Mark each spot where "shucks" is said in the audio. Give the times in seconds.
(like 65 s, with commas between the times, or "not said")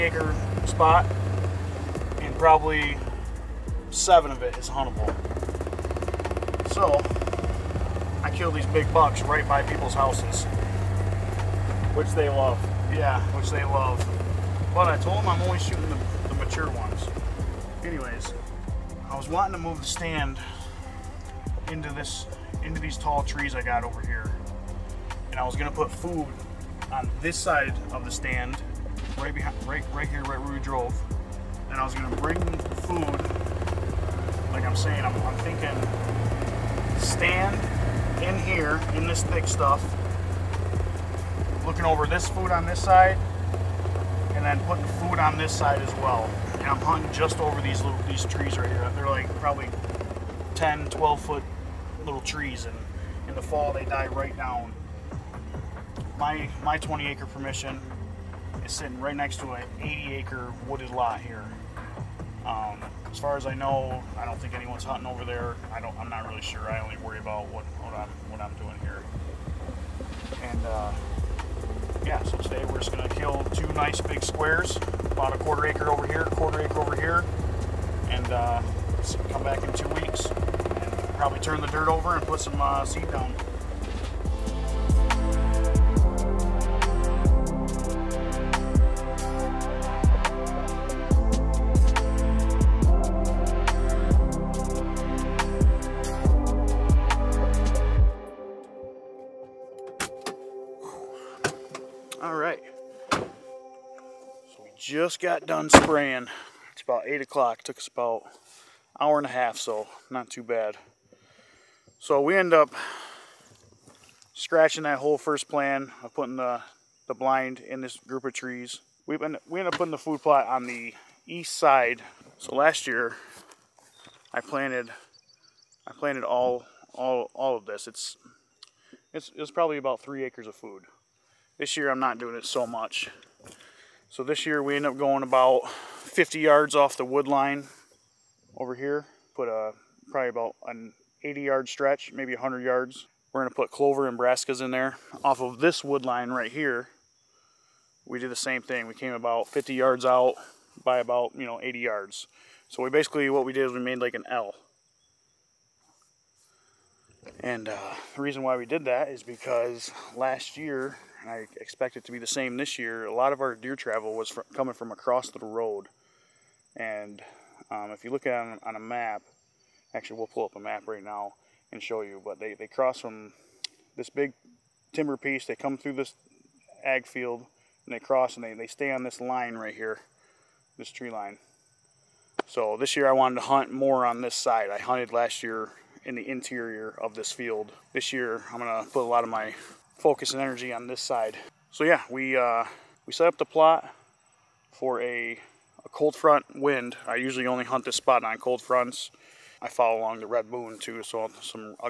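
not said.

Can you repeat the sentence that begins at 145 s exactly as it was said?
Off of this wood line right here, we did the same thing.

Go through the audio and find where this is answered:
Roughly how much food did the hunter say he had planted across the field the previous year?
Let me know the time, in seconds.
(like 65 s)
129 s.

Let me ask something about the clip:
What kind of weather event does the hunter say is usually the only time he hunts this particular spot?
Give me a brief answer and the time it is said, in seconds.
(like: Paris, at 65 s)
Cold fronts, at 198 s.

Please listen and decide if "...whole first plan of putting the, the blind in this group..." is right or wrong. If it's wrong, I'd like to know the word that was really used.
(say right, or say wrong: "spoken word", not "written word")
right.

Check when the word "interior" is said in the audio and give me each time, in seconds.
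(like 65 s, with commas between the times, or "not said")
186 s.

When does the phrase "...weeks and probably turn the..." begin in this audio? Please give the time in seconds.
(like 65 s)
79 s.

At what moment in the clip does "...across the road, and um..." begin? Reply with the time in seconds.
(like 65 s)
164 s.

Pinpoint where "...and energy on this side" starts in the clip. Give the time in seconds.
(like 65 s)
190 s.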